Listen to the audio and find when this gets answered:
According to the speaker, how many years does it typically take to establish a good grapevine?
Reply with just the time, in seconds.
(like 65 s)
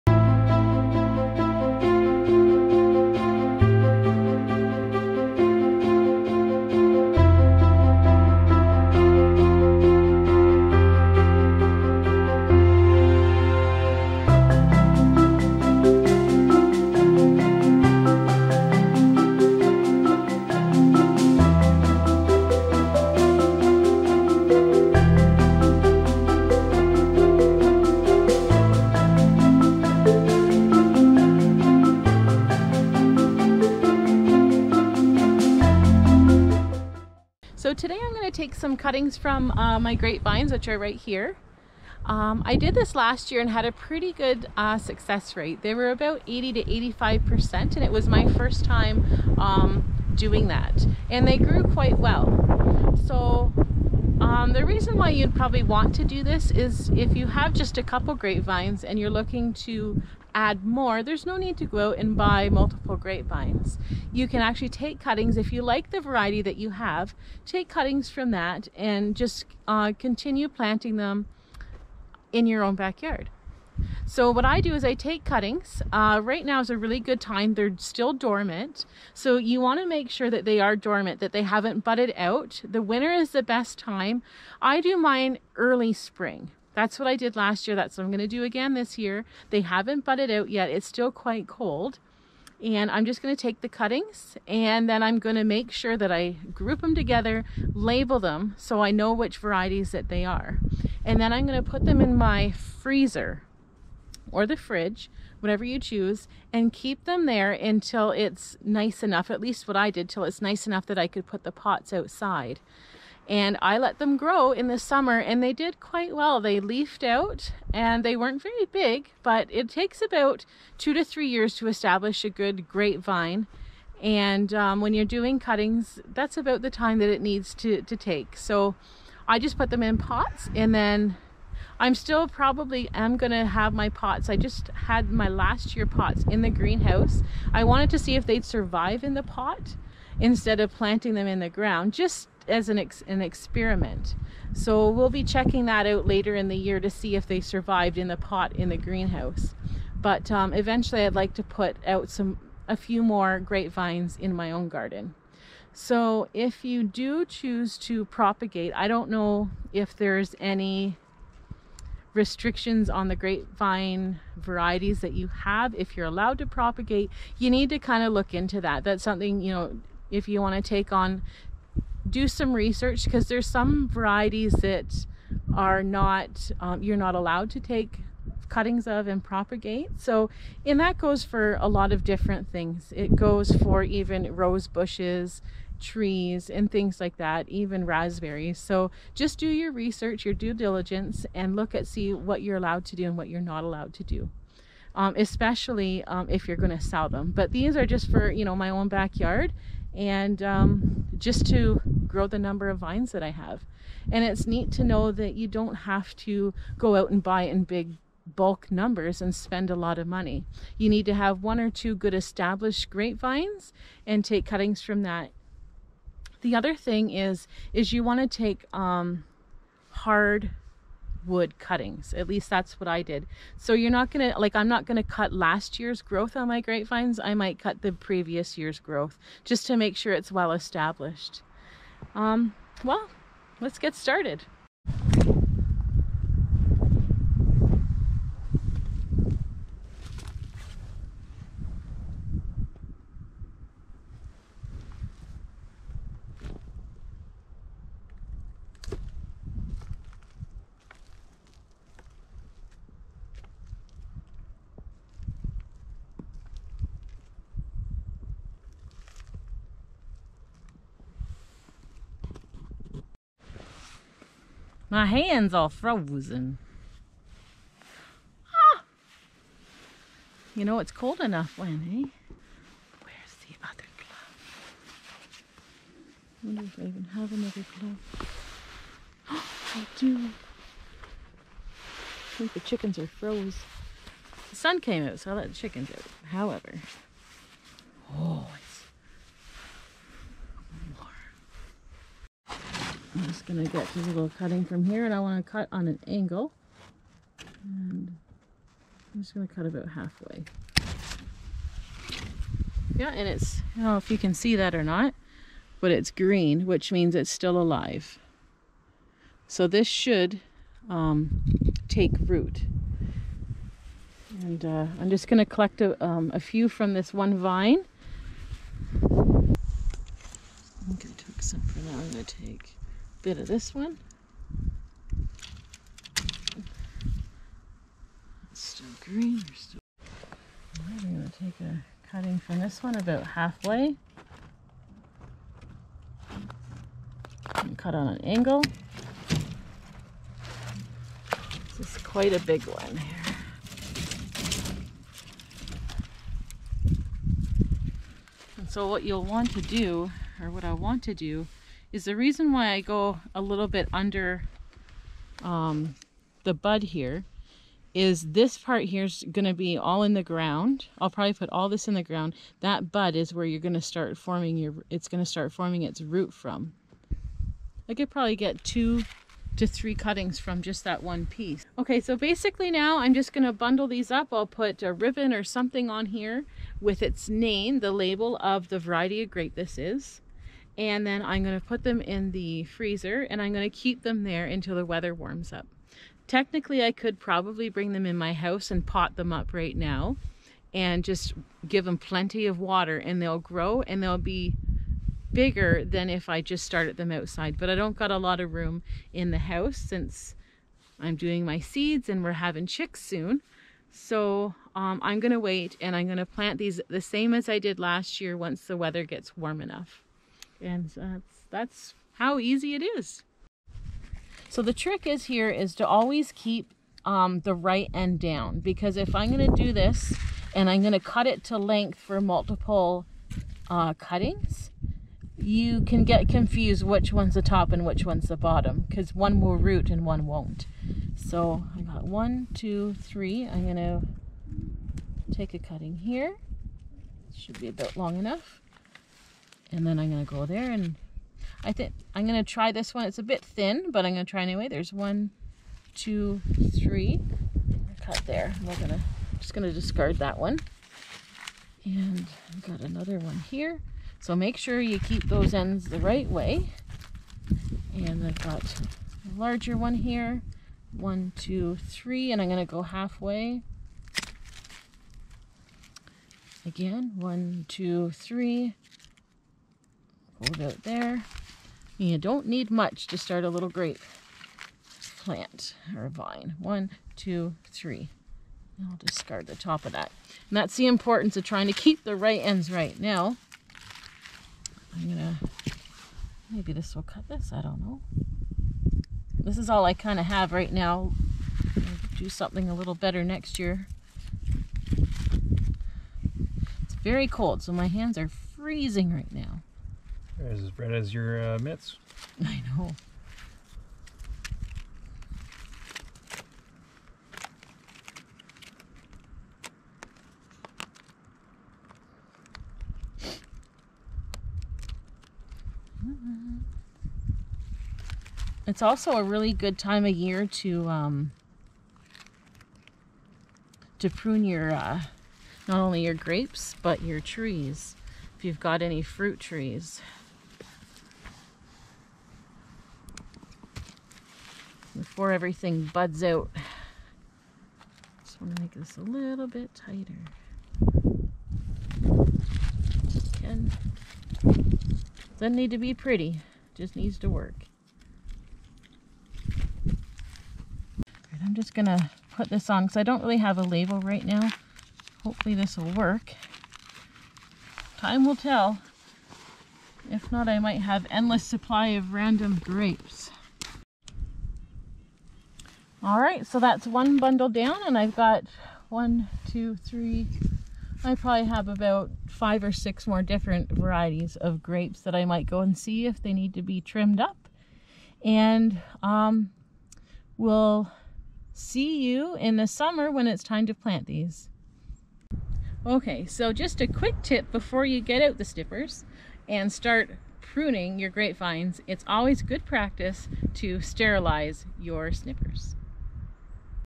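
120 s.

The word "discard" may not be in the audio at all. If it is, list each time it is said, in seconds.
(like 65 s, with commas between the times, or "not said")
449 s, 478 s.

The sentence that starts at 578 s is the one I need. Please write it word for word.
And um, we'll see you in the summer when it's time to plant these.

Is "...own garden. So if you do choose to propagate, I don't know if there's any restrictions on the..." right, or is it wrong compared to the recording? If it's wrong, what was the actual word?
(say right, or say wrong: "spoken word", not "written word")
right.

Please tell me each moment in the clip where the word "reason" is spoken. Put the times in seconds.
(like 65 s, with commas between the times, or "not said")
54 s, 352 s.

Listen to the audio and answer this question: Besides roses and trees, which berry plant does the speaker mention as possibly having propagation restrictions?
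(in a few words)
raspberries.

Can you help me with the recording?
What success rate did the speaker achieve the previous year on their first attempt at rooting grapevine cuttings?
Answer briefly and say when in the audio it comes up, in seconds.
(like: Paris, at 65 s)
80 to 85%, at 46 s.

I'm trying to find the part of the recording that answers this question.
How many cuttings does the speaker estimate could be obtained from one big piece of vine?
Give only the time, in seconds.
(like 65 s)
368 s.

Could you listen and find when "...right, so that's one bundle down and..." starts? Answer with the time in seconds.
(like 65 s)
566 s.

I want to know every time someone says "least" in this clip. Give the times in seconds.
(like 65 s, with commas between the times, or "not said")
109 s, 222 s.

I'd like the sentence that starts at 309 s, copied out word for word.
So this should um, take root.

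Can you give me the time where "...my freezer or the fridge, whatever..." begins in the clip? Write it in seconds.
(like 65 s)
102 s.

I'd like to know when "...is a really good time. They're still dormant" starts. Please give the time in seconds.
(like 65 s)
76 s.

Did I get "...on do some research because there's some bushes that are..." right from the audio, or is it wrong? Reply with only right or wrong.
wrong.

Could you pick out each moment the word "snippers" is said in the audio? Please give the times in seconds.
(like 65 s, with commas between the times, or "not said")
588 s, 595 s.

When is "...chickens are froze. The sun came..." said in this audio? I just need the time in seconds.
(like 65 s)
282 s.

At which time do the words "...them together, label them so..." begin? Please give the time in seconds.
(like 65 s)
96 s.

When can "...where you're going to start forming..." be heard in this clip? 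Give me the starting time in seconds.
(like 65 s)
363 s.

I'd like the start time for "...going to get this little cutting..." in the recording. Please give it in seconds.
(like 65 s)
293 s.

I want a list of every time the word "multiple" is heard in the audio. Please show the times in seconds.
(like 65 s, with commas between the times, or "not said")
62 s, 422 s.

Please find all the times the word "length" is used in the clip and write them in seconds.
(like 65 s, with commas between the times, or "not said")
421 s.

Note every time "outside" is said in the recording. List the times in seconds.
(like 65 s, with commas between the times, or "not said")
111 s, 397 s.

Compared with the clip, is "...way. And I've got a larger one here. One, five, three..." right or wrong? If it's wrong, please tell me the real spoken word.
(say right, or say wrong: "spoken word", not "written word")
wrong: "two", not "five".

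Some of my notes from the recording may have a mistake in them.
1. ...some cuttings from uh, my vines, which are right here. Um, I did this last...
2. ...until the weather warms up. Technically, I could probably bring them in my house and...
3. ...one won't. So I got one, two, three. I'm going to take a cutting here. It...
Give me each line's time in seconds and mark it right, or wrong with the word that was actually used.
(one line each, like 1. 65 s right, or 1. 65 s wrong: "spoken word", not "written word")
1. 38 s wrong: "grapevines", not "vines"
2. 384 s right
3. 430 s right.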